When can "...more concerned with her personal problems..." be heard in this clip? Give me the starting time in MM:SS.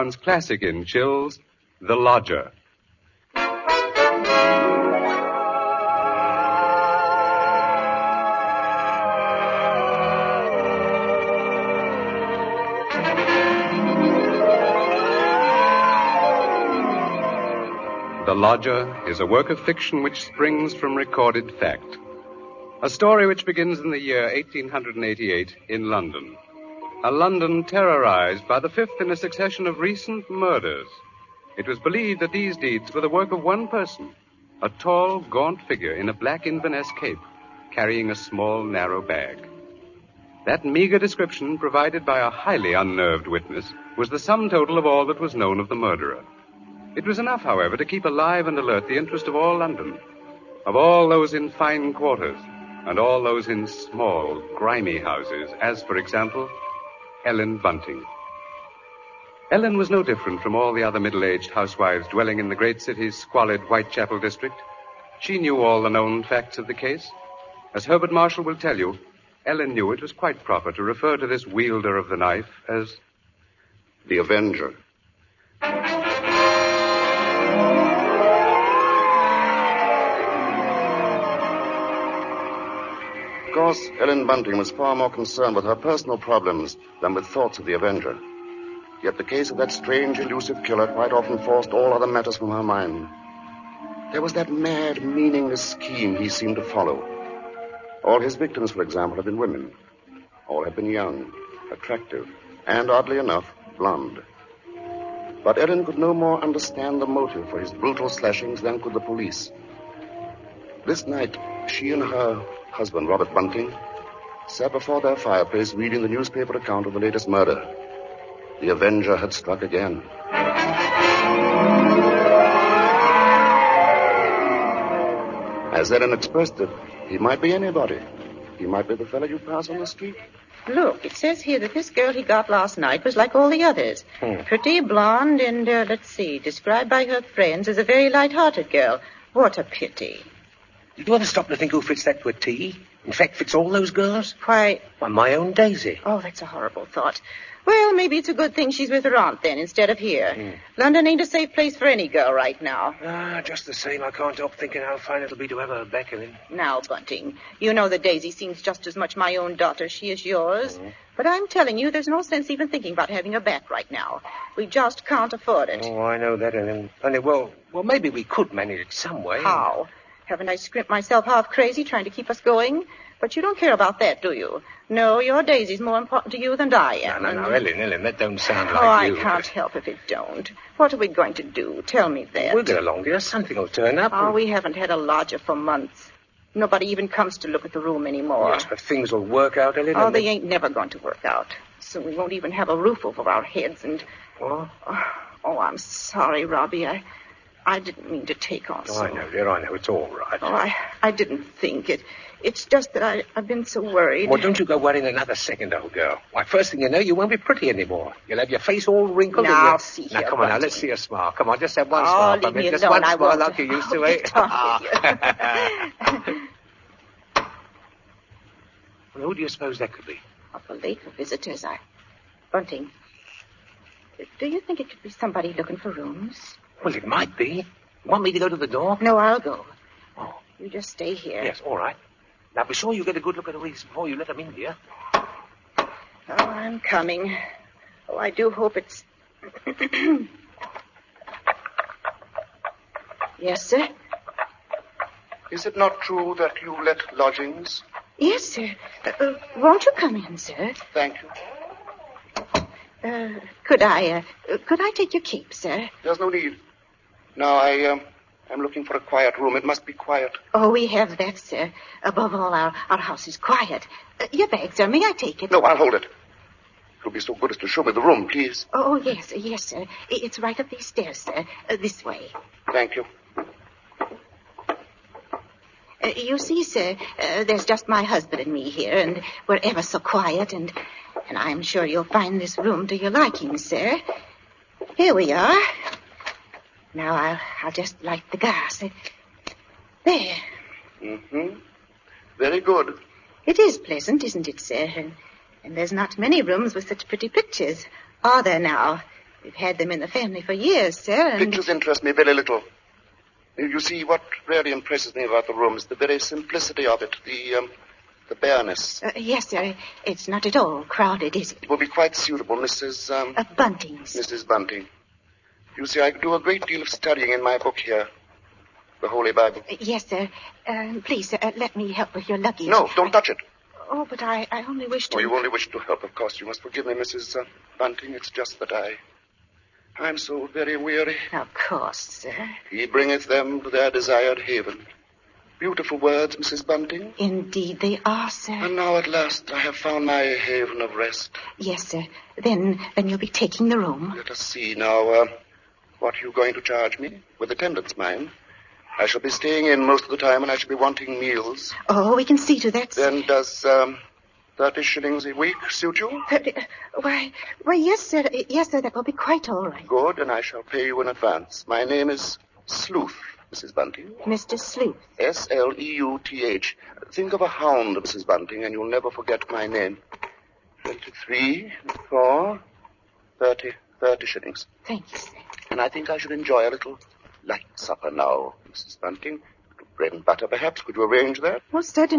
01:24.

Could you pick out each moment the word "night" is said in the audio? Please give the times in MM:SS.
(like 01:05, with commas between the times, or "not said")
01:51, 02:12.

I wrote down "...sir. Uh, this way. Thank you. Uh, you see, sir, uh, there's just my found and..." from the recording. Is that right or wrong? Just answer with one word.
wrong.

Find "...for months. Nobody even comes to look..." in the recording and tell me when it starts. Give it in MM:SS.
03:05.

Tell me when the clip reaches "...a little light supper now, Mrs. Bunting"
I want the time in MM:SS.
06:16.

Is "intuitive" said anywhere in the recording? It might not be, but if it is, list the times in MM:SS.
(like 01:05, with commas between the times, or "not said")
not said.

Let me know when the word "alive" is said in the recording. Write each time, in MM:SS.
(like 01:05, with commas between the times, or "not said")
00:48.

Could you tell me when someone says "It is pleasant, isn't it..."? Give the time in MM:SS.
04:53.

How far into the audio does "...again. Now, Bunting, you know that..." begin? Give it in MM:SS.
02:36.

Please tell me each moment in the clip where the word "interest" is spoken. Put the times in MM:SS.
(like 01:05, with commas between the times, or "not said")
00:48, 05:01.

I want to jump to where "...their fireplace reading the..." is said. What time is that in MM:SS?
01:55.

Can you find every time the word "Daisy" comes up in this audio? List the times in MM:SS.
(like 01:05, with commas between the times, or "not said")
02:25, 02:38, 02:55.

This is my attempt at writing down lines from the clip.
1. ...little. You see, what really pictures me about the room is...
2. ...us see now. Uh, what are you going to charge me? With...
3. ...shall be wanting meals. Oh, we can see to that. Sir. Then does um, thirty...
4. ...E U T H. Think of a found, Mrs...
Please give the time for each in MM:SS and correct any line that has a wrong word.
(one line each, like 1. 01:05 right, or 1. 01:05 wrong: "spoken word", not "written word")
1. 05:02 wrong: "impresses", not "pictures"
2. 05:44 right
3. 05:50 right
4. 06:05 wrong: "hound", not "found".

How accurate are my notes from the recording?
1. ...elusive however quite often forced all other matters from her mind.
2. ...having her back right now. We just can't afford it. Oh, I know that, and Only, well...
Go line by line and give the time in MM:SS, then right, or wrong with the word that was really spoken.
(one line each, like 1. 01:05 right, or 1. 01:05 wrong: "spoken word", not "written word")
1. 01:30 wrong: "killer", not "however"
2. 02:43 right.